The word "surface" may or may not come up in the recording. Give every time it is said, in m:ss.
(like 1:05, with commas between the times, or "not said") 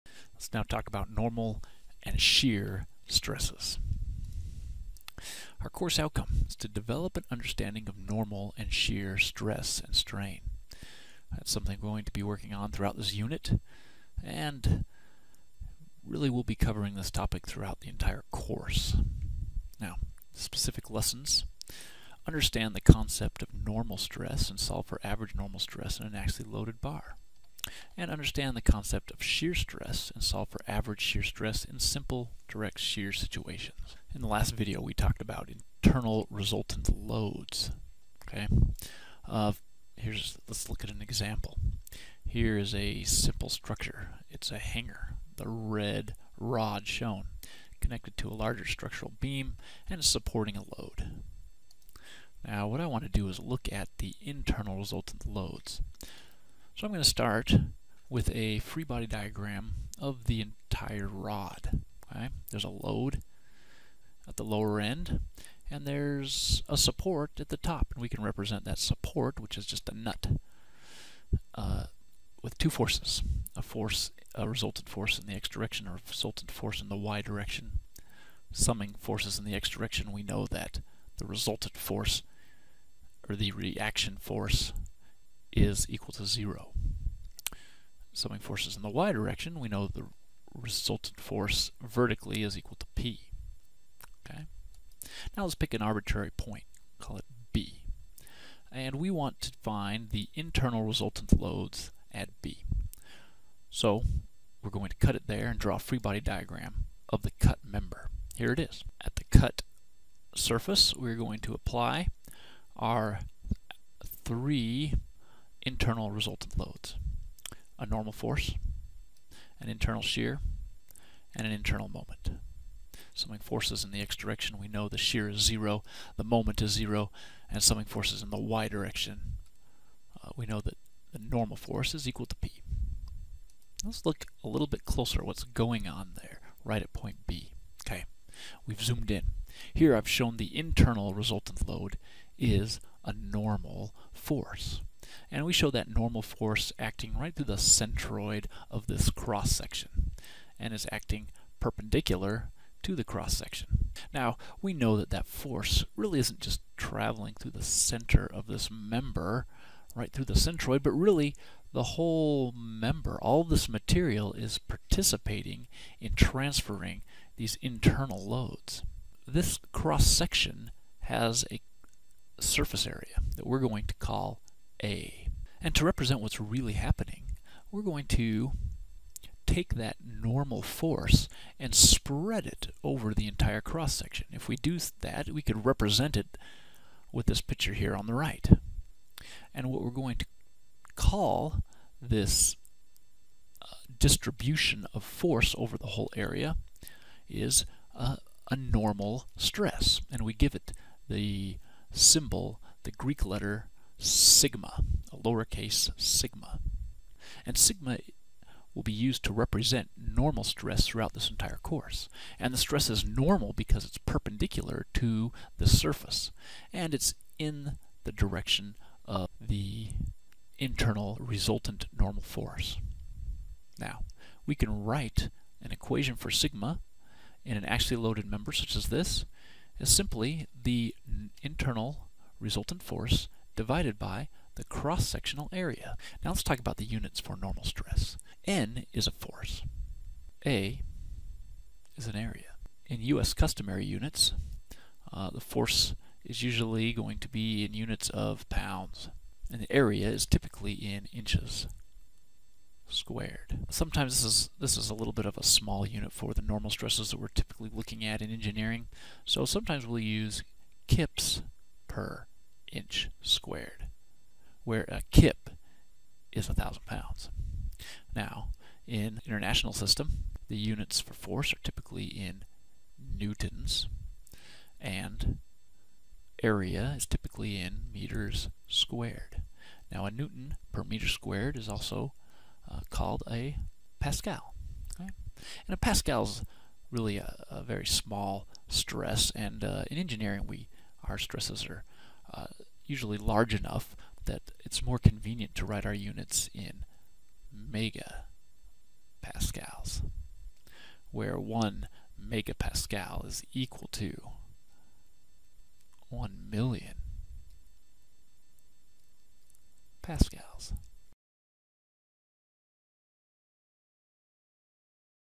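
1:50, 2:52, 3:35.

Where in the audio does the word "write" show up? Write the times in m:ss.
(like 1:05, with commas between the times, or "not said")
3:44, 4:55.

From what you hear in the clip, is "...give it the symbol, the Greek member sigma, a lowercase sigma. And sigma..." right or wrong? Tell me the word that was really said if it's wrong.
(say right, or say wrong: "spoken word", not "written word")
wrong: "letter", not "member".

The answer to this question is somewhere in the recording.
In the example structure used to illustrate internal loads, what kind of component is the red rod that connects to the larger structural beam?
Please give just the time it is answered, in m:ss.
0:44.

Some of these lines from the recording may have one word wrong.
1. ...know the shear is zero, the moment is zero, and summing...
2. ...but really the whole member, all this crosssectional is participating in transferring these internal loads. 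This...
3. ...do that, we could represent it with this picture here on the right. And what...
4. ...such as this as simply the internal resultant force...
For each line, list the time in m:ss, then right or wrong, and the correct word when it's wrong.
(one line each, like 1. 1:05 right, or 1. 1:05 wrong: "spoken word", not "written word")
1. 2:04 right
2. 2:40 wrong: "material", not "crosssectional"
3. 3:04 right
4. 3:48 right.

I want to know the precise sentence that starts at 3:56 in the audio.
Now let's talk about the units for normal stress.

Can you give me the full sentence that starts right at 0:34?
In the last video we talked about internal resultant loads.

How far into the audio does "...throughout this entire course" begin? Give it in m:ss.
3:30.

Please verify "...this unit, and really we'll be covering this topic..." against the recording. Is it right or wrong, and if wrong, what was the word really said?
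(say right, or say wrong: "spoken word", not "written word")
right.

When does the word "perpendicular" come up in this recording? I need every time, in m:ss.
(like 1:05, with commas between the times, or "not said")
2:31, 3:33.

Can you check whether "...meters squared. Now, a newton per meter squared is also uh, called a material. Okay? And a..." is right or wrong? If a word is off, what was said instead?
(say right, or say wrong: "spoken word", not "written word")
wrong: "pascal", not "material".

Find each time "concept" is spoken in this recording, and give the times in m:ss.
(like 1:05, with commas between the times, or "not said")
0:22, 0:28.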